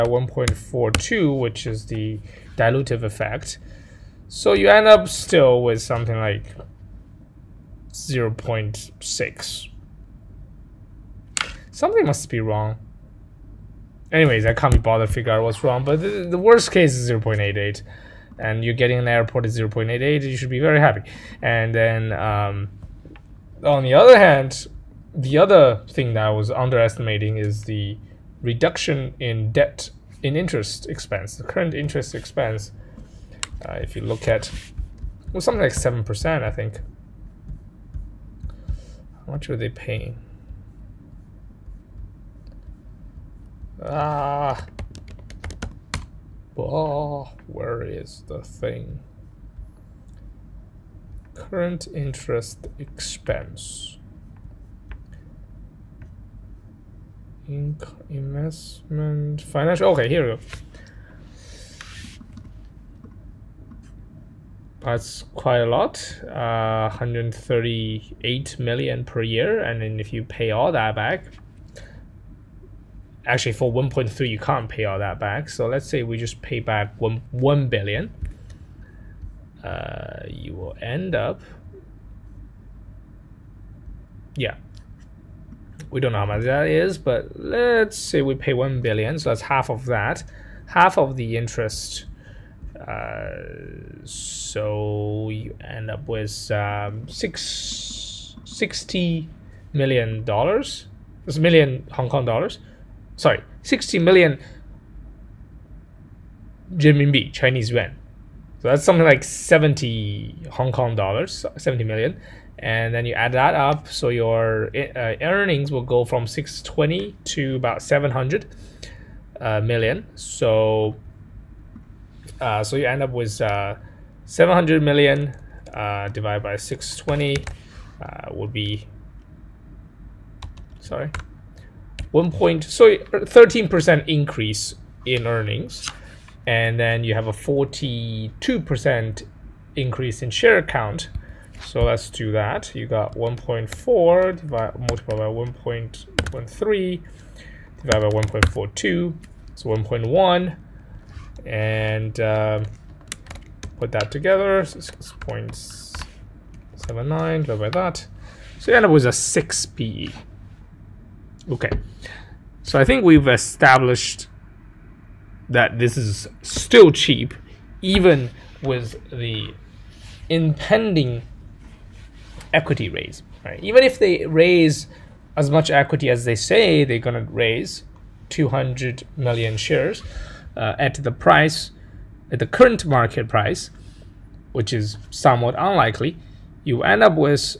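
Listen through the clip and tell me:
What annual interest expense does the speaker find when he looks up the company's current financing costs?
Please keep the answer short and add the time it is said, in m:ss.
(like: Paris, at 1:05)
138 million, at 1:06.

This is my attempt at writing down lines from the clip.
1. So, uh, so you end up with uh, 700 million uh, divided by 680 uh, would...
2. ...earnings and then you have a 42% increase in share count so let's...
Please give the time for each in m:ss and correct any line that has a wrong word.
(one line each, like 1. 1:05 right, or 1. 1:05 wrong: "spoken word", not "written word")
1. 2:00 wrong: "620", not "680"
2. 2:15 right.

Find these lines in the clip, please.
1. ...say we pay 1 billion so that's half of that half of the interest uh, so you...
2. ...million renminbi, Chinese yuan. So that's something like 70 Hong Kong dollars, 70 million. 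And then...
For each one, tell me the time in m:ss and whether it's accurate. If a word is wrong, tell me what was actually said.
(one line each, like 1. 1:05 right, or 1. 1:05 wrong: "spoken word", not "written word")
1. 1:27 right
2. 1:43 right.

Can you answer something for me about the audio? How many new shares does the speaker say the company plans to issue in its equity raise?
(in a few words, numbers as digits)
200 million.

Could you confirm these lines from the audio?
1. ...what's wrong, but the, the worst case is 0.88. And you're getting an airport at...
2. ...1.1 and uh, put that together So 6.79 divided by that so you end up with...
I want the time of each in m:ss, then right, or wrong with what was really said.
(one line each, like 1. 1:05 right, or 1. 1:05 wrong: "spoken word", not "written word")
1. 0:15 right
2. 2:29 right.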